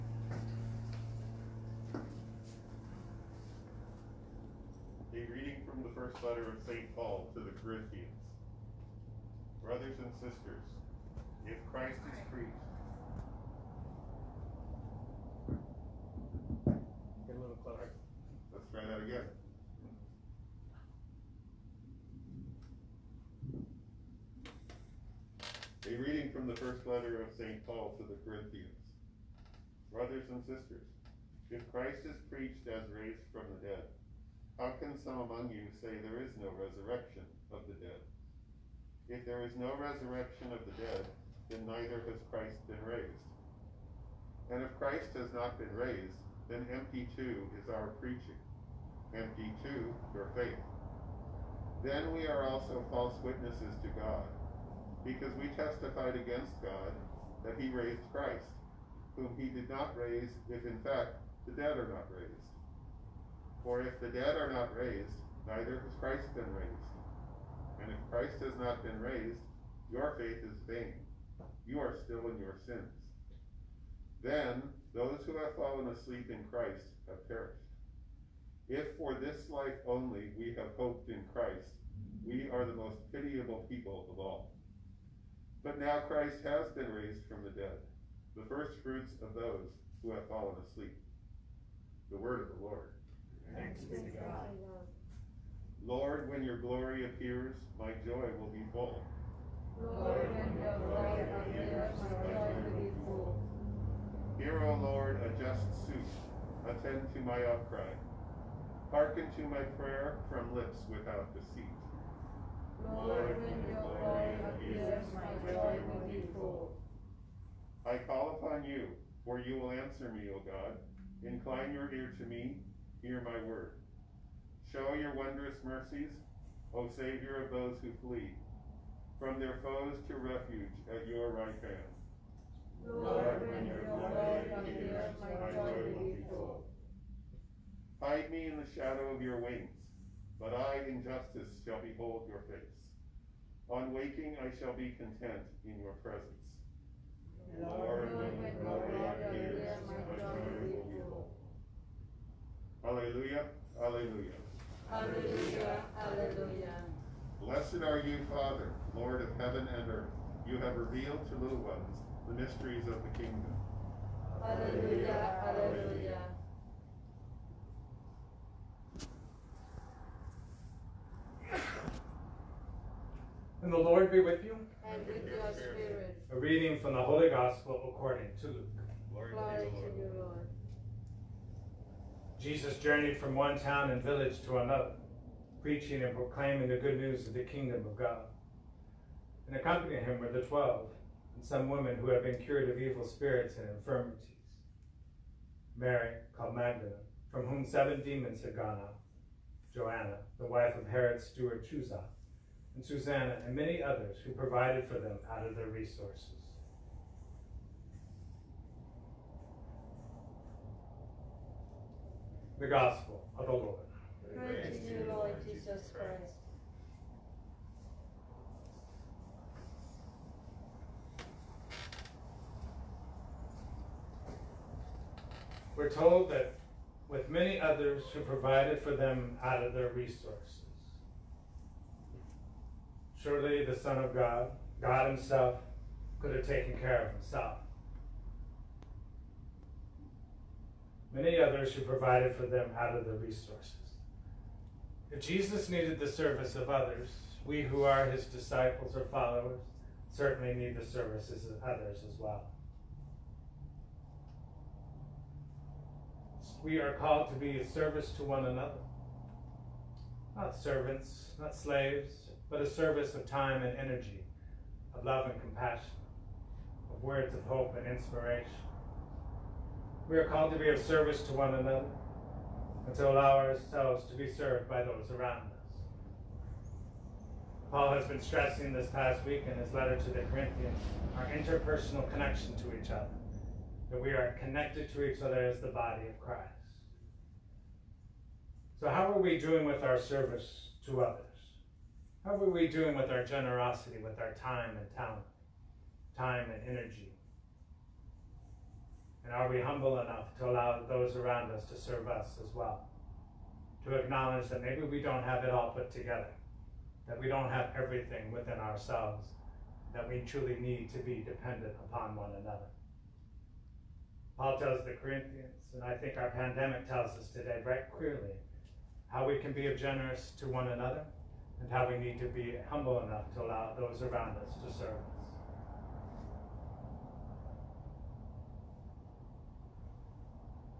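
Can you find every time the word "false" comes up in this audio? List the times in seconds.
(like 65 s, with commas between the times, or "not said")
52 s.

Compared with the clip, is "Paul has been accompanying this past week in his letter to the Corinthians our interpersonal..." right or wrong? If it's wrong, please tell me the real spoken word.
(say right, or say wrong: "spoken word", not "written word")
wrong: "stressing", not "accompanying".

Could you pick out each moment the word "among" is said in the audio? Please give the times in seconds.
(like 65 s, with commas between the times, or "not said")
35 s.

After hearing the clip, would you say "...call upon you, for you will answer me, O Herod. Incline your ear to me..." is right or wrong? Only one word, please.
wrong.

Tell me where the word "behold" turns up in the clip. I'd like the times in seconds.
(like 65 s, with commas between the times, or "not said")
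141 s.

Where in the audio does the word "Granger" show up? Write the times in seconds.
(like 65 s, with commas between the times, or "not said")
not said.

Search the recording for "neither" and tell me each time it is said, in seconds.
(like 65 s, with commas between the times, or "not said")
41 s, 65 s.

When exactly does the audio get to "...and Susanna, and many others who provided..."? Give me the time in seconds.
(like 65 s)
202 s.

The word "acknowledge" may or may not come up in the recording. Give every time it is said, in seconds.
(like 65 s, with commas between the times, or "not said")
303 s.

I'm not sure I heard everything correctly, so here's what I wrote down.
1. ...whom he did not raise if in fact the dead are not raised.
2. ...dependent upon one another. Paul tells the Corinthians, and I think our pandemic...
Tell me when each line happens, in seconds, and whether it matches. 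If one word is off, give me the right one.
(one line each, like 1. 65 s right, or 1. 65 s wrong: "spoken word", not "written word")
1. 59 s right
2. 311 s right.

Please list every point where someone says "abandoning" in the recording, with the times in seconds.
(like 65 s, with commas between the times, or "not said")
not said.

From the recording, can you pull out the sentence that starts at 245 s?
If Jesus needed the service of others, we who are his disciples or followers certainly need the services of others as well.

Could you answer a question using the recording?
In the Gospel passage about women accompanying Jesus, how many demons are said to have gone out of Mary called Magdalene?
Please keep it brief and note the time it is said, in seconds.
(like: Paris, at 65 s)
7, at 197 s.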